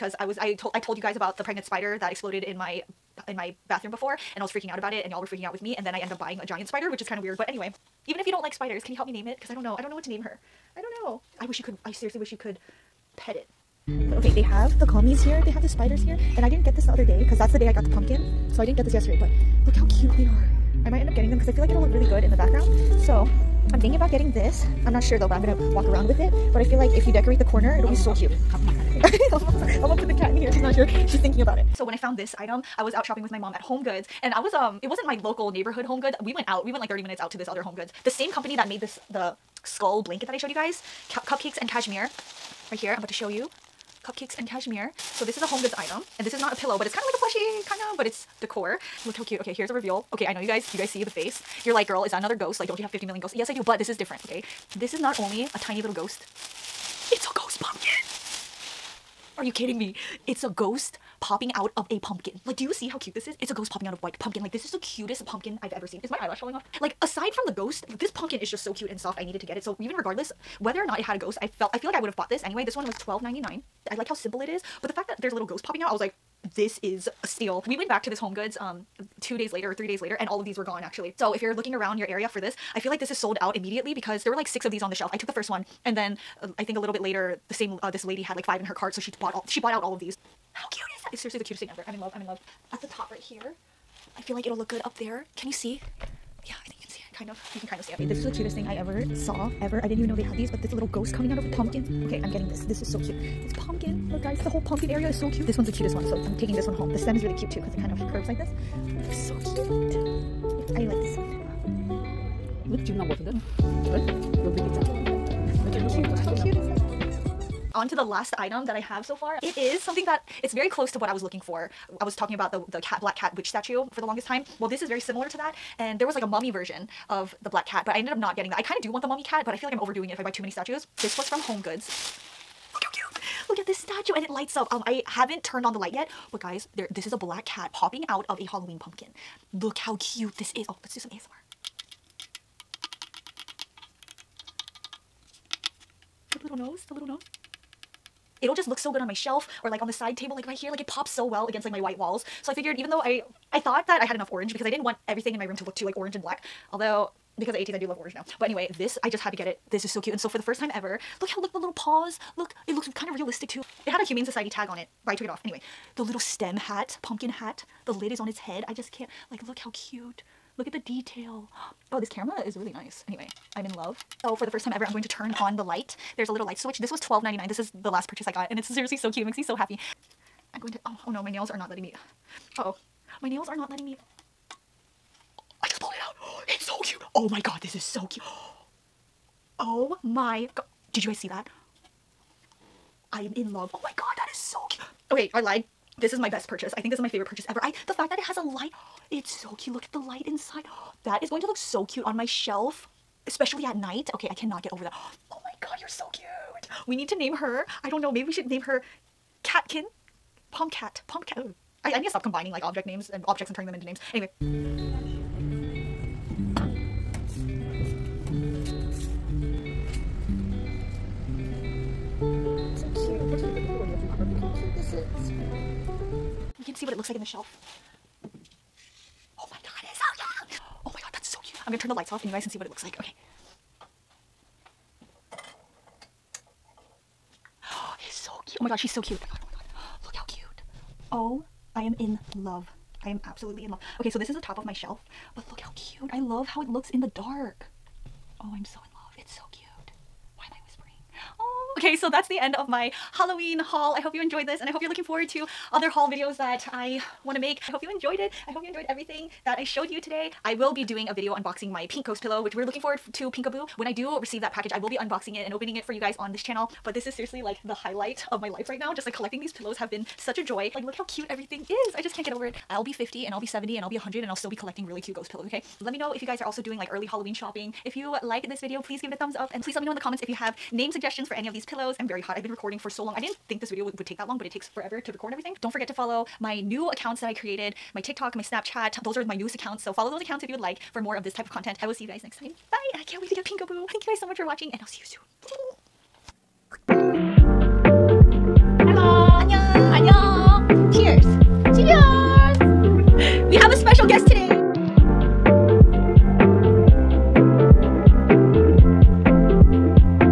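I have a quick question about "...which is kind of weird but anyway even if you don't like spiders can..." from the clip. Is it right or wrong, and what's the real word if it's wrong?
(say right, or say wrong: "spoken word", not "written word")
right.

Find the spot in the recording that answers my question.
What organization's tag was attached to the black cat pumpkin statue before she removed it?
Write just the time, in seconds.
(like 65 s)
164 s.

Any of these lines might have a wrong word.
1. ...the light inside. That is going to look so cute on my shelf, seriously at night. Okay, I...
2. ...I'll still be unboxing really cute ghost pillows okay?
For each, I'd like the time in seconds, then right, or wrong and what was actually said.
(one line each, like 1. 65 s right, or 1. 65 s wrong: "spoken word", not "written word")
1. 199 s wrong: "especially", not "seriously"
2. 274 s wrong: "collecting", not "unboxing".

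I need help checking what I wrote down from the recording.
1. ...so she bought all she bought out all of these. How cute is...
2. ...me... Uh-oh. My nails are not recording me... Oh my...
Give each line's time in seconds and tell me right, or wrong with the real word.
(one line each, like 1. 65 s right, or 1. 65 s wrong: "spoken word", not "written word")
1. 88 s right
2. 181 s wrong: "letting", not "recording".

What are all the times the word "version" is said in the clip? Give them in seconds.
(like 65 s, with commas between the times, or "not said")
126 s.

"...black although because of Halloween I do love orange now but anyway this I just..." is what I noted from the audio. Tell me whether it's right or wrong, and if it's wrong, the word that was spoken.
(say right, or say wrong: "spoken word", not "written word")
wrong: "ATEEZ", not "Halloween".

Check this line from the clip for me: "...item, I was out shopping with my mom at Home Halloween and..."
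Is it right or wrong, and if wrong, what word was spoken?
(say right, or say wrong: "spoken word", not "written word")
wrong: "Goods", not "Halloween".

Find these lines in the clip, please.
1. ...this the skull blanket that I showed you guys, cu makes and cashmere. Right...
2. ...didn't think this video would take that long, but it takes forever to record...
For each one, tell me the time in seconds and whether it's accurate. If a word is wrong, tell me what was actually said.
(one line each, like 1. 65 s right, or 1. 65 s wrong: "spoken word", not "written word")
1. 38 s wrong: "cupcakes", not "makes"
2. 283 s right.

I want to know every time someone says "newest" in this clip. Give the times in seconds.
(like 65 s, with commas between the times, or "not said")
289 s.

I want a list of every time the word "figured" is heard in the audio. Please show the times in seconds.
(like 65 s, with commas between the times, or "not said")
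152 s.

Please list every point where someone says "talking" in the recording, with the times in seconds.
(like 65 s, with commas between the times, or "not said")
122 s.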